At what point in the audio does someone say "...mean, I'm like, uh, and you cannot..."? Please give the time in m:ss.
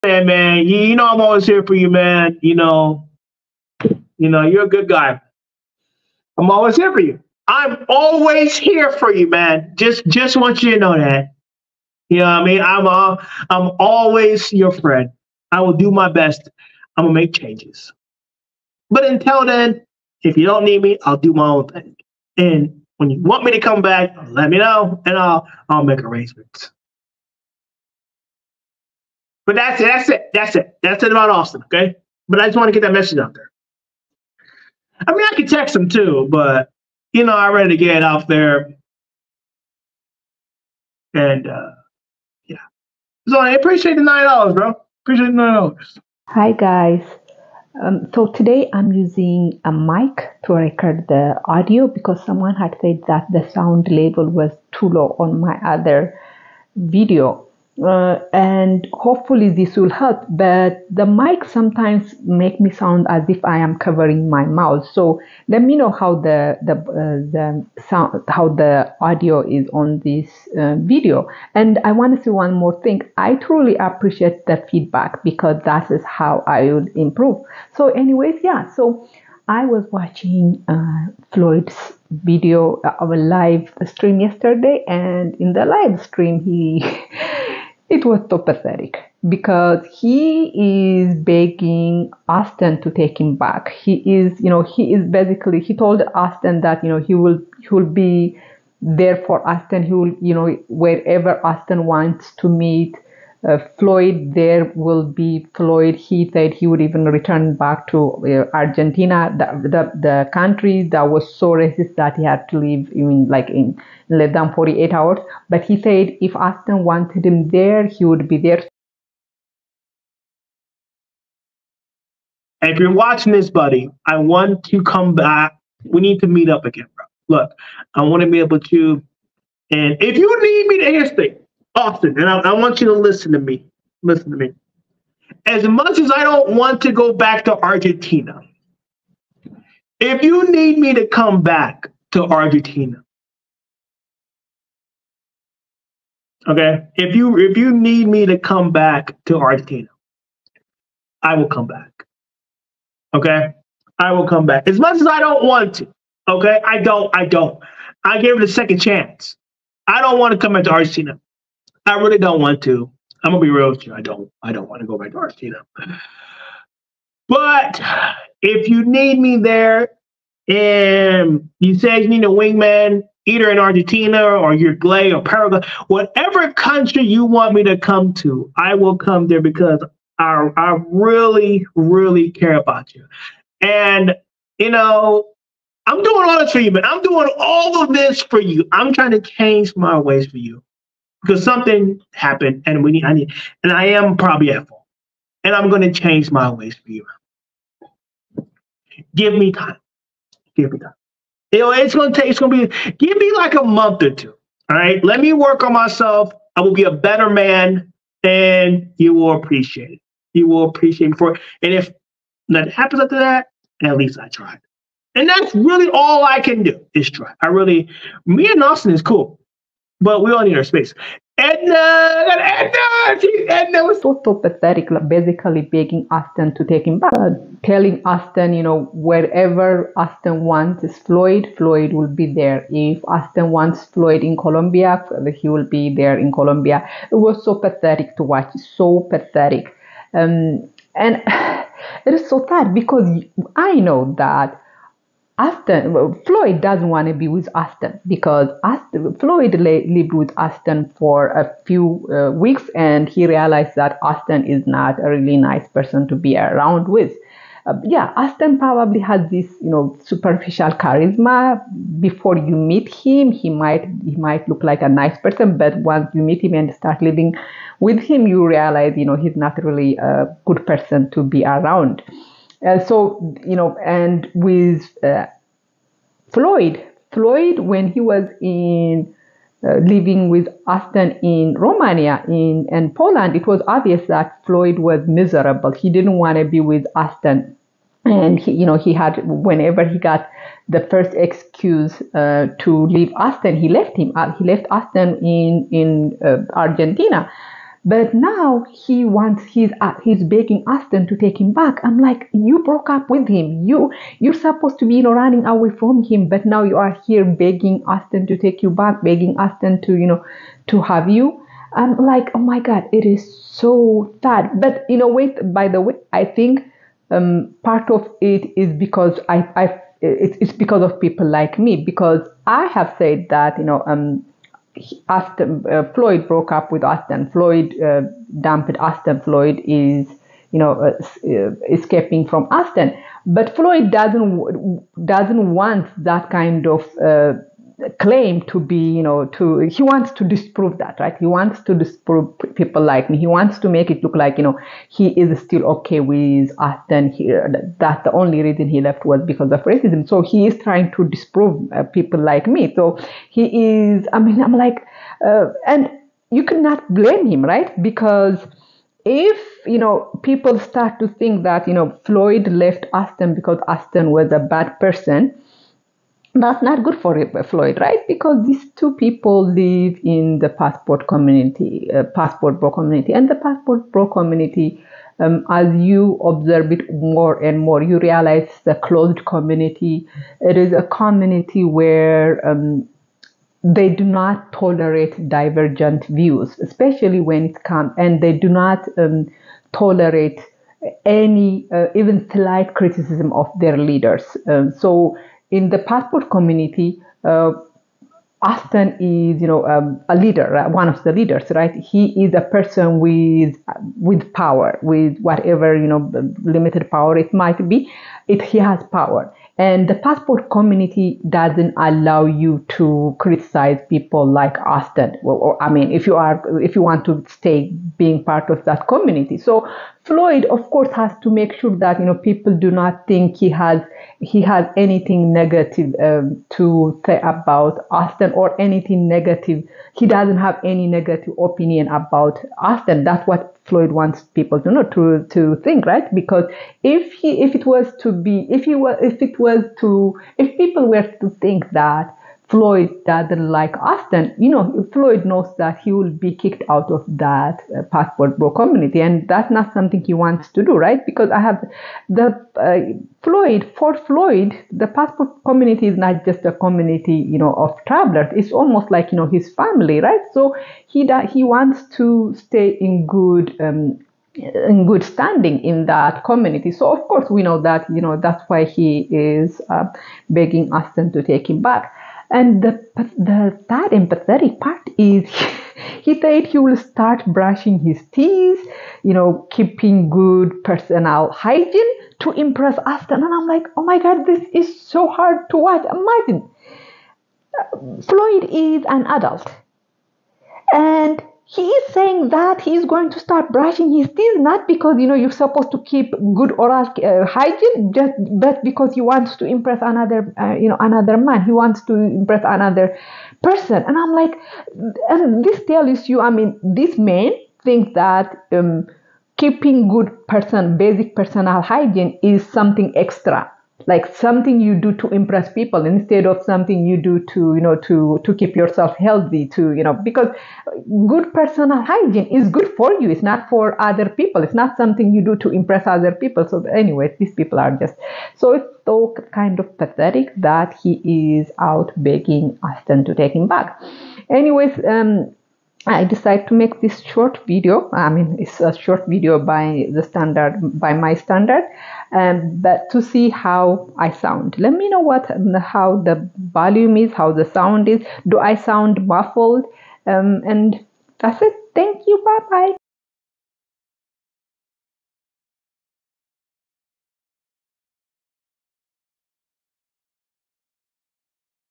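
5:54.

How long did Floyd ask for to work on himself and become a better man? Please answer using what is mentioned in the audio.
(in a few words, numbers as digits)
A month or two.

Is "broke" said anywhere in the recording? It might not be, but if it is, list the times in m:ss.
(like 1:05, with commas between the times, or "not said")
5:02, 5:26.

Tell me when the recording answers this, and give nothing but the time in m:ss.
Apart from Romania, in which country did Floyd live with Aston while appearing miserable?
4:42.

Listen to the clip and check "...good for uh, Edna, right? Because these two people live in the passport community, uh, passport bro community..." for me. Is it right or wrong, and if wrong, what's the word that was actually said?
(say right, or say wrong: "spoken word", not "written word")
wrong: "Floyd", not "Edna".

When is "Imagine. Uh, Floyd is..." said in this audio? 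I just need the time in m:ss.
8:05.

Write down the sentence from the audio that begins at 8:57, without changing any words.
I mean, it's a short video by the standard, by my standard, um, but to see how I sound.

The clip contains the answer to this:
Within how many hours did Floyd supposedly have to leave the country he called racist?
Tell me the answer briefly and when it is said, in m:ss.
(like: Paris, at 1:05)
48, at 1:54.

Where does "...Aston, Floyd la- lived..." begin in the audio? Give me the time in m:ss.
4:08.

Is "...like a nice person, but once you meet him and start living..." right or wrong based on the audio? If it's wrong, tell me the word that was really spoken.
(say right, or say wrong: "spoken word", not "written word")
right.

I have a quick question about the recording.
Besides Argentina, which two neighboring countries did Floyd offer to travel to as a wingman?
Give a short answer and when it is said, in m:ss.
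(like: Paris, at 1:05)
Uruguay or Paraguay, at 2:54.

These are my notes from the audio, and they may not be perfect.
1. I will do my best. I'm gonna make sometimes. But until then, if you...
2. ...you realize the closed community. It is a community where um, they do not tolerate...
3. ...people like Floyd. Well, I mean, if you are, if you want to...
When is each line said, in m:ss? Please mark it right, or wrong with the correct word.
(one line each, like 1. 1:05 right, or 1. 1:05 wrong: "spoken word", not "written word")
1. 0:15 wrong: "changes", not "sometimes"
2. 6:17 right
3. 6:53 wrong: "Aston", not "Floyd".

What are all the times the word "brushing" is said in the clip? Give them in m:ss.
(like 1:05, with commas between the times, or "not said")
7:57, 8:13.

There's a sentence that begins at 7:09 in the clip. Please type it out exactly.
He doesn't have any negative opinion about Auston.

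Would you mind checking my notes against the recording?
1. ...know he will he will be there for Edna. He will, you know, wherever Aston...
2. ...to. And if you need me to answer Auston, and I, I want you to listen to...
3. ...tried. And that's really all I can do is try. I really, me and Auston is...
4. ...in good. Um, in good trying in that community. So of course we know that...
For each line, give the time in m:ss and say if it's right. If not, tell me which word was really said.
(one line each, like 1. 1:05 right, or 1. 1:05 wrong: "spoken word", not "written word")
1. 1:36 wrong: "Aston", not "Edna"
2. 2:08 right
3. 3:34 right
4. 7:42 wrong: "standing", not "trying".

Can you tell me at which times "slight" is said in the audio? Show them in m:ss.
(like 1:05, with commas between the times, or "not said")
6:32.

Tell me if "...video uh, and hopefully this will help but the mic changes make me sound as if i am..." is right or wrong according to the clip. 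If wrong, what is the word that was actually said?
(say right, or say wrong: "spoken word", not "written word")
wrong: "sometimes", not "changes".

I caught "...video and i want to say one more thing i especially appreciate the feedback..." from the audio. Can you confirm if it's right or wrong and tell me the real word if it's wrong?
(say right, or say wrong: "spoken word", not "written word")
wrong: "truly", not "especially".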